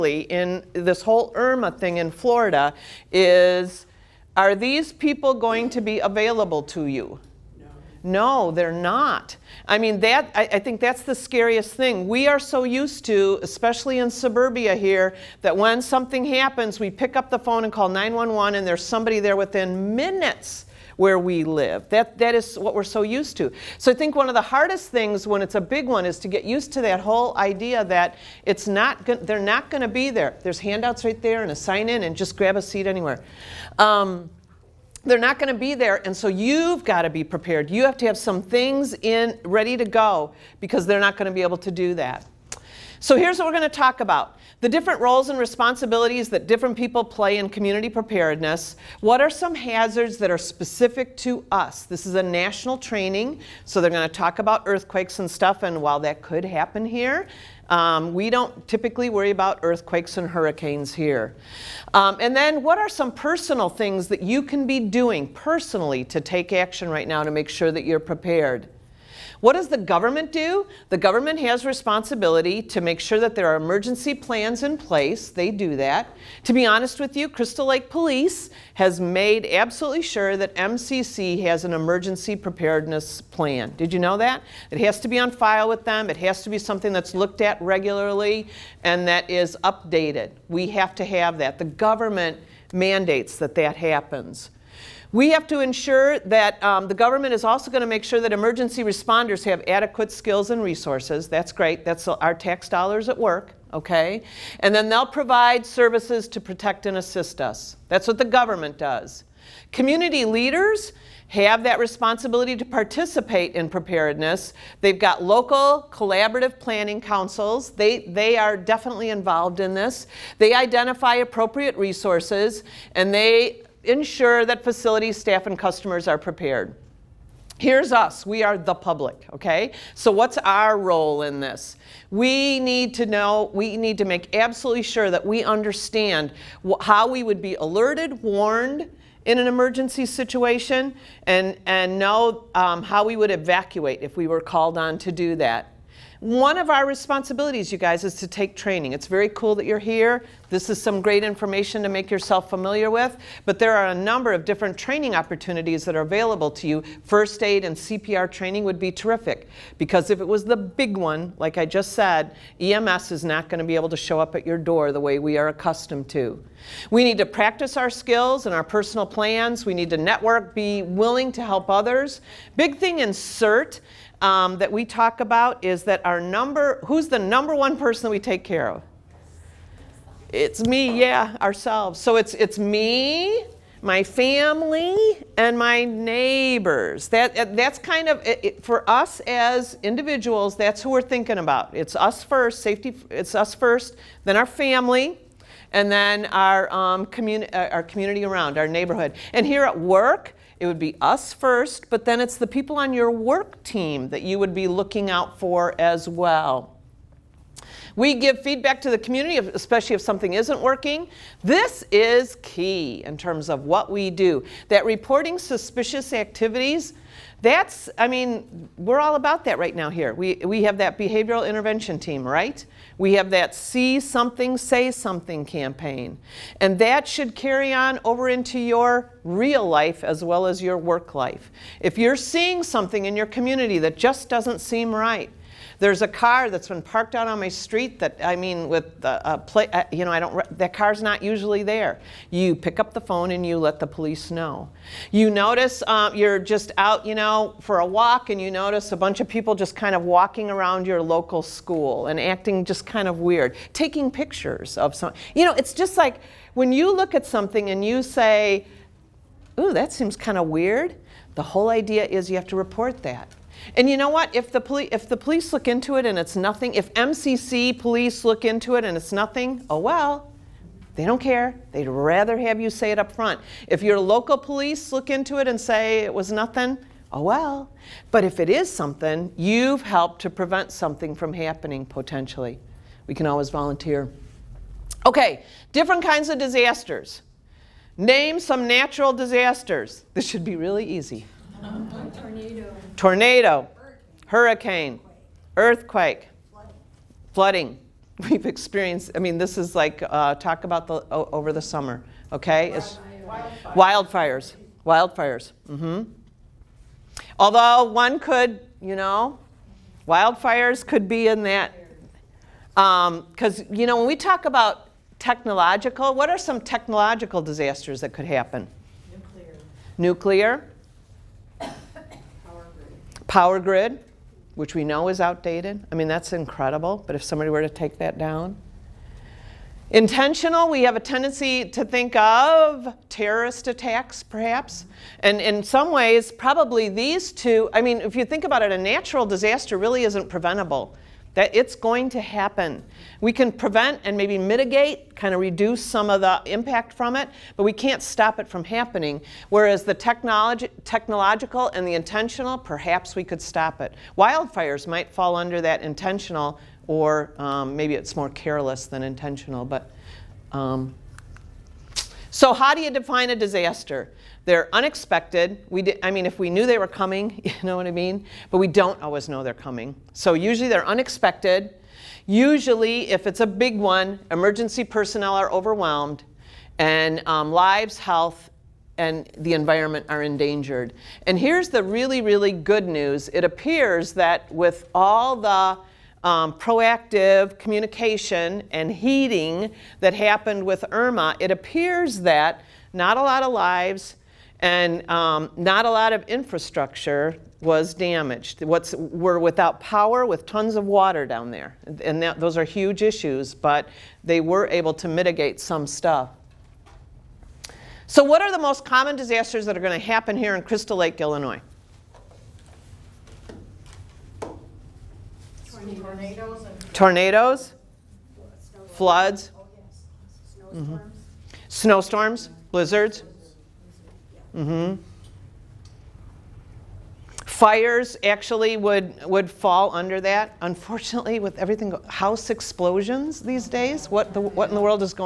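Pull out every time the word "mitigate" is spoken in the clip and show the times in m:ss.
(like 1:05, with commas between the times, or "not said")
5:44, 6:45.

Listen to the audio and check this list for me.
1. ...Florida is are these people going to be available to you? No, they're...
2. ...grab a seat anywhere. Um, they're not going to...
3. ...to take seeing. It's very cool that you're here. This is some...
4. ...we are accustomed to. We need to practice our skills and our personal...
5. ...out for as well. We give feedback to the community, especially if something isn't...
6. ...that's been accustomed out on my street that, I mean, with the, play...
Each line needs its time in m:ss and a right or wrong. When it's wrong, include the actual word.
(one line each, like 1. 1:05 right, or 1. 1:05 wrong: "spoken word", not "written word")
1. 0:02 right
2. 0:32 right
3. 2:28 wrong: "training", not "seeing"
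4. 2:45 right
5. 3:25 right
6. 3:56 wrong: "parked", not "accustomed".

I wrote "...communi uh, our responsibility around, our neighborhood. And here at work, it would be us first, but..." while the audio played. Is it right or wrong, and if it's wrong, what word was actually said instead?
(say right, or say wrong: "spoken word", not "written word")
wrong: "community", not "responsibility".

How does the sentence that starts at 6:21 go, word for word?
And here's the really, really good news.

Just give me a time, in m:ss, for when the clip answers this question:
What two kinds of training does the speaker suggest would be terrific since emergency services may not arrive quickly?
2:37.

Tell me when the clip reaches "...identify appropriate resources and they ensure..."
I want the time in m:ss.
2:00.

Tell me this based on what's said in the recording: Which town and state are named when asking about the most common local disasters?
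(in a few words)
Crystal Lake, Illinois.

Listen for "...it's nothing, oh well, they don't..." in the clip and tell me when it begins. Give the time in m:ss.
4:28.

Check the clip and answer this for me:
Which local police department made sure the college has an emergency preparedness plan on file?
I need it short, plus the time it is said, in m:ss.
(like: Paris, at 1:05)
Crystal Lake Police, at 1:17.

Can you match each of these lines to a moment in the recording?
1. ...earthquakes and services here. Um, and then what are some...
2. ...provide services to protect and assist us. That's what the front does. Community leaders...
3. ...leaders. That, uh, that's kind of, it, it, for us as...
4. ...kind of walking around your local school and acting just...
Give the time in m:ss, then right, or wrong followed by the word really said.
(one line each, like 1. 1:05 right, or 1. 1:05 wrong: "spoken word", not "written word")
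1. 0:59 wrong: "hurricanes", not "services"
2. 1:45 wrong: "government", not "front"
3. 3:05 wrong: "neighbors", not "leaders"
4. 4:09 right.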